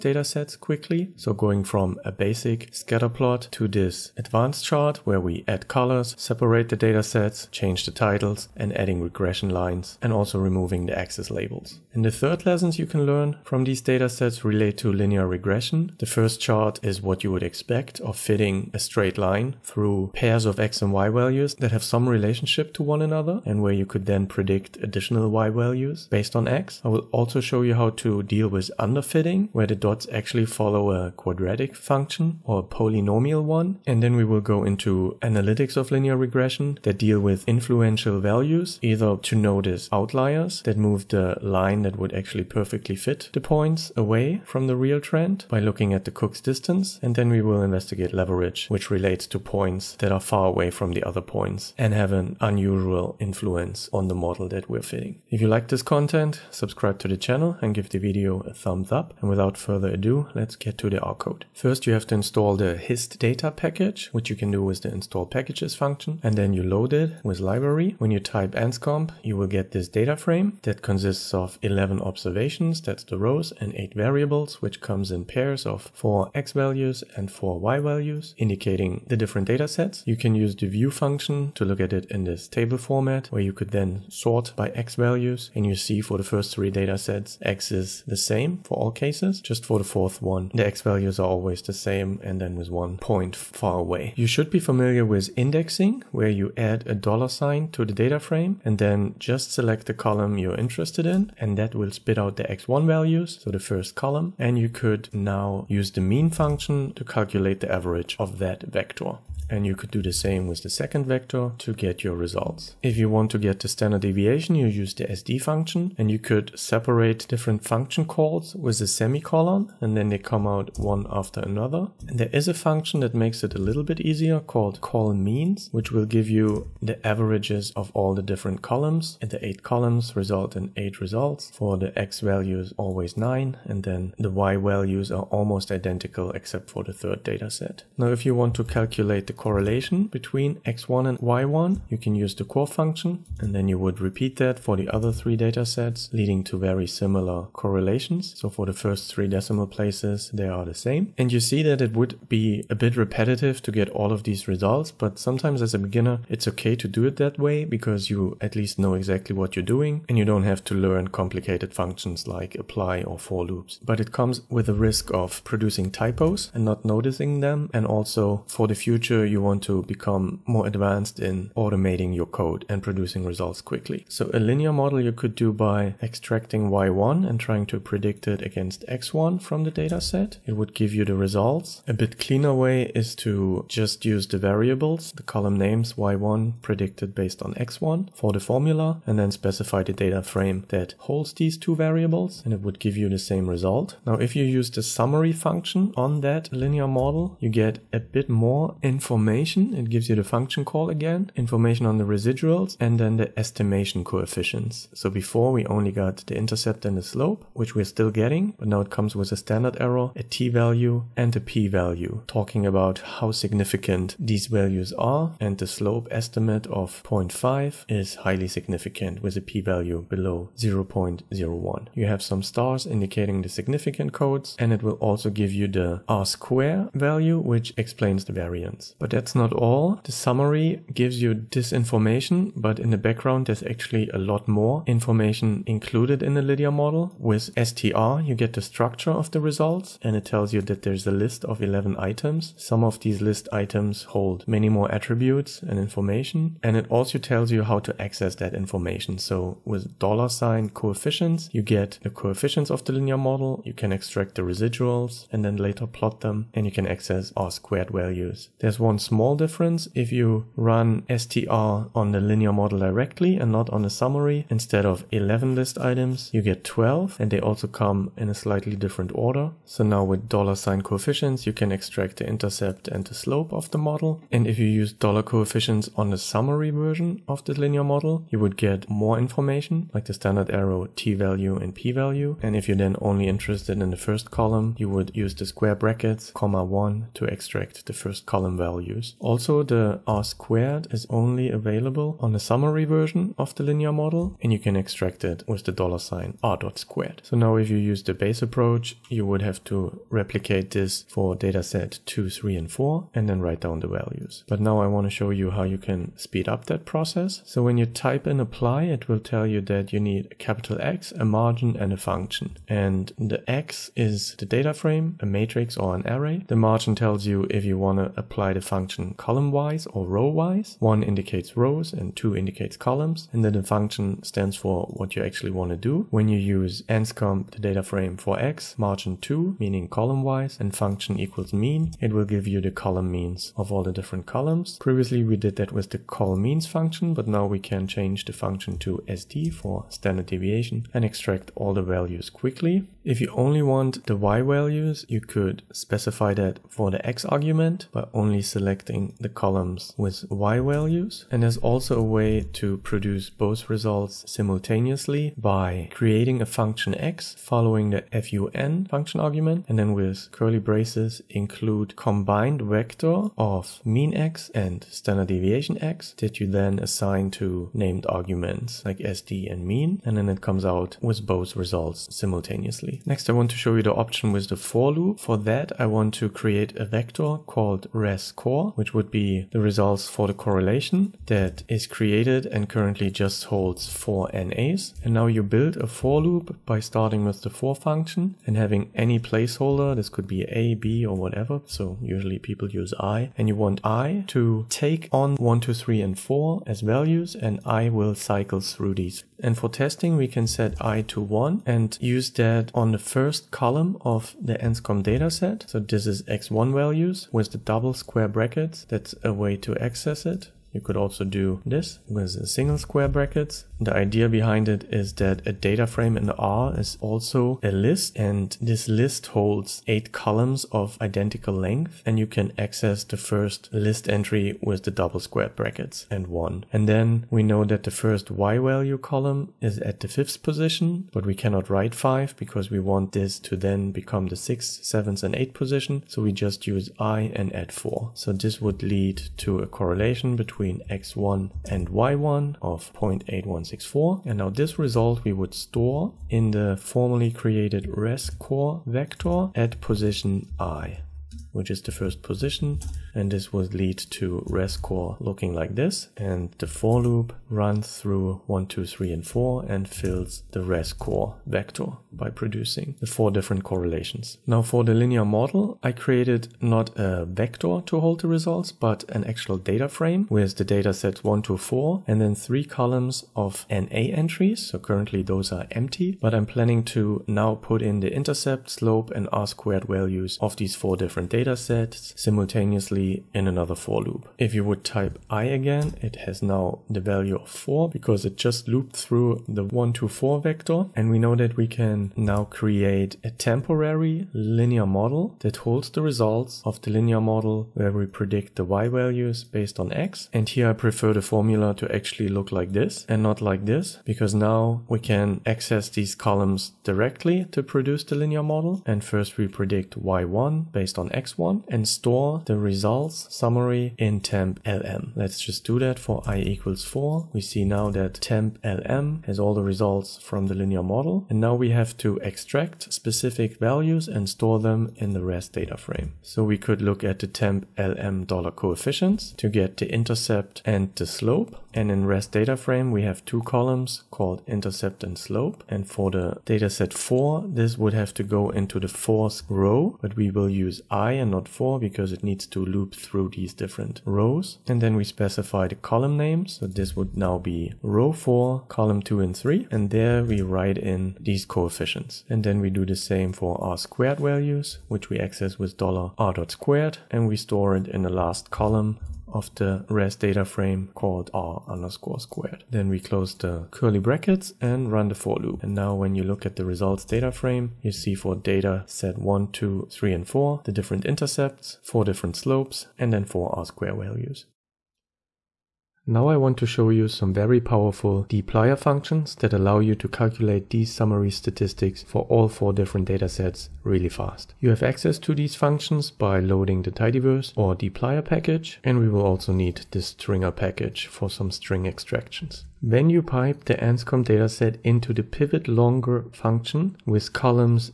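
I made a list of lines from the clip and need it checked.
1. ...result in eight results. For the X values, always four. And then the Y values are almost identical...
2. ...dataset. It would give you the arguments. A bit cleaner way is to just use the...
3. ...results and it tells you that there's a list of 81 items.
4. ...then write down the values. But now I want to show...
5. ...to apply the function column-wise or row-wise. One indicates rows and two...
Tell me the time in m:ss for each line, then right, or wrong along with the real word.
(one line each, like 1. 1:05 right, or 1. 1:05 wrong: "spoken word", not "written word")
1. 2:10 wrong: "nine", not "four"
2. 2:59 wrong: "results", not "arguments"
3. 3:59 wrong: "11", not "81"
4. 5:03 right
5. 5:17 right.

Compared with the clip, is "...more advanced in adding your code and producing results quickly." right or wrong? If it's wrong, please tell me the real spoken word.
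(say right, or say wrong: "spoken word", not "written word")
wrong: "automating", not "adding".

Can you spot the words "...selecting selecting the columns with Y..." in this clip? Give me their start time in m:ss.
5:48.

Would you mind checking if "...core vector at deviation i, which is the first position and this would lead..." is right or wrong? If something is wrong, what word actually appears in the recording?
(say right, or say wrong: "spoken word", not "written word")
wrong: "position", not "deviation".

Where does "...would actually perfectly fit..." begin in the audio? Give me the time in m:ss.
0:41.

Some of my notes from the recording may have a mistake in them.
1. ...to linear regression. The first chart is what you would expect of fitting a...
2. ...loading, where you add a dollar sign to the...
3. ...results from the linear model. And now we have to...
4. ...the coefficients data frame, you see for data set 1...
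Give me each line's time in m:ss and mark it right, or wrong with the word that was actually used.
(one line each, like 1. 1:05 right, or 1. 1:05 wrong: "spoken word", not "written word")
1. 0:14 right
2. 1:35 wrong: "indexing", not "loading"
3. 8:39 right
4. 9:26 wrong: "results", not "coefficients".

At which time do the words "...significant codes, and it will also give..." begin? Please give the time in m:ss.
3:43.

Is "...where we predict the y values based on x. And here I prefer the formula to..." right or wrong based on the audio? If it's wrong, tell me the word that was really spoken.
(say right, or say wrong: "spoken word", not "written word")
right.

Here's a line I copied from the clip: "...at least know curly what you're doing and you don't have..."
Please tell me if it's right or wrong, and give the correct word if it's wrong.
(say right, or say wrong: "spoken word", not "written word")
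wrong: "exactly", not "curly".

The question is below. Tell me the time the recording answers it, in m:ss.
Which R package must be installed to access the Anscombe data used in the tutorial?
1:02.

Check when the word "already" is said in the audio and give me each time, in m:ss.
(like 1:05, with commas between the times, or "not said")
8:03.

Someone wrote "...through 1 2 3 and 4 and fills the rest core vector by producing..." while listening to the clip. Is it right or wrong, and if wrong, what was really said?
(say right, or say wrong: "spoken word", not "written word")
right.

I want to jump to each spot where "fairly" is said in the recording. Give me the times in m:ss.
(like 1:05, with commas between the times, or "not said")
not said.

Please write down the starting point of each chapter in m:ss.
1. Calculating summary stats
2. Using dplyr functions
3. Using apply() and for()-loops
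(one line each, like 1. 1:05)
1. 1:01
2. 9:34
3. 5:02.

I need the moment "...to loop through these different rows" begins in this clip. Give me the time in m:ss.
9:02.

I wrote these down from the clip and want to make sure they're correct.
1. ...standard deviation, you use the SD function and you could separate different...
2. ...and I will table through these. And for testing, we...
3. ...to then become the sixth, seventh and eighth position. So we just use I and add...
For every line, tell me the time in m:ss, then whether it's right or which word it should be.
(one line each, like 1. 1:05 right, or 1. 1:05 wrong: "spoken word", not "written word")
1. 1:53 right
2. 6:37 wrong: "cycle", not "table"
3. 7:13 right.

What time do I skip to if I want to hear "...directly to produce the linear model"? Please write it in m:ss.
8:26.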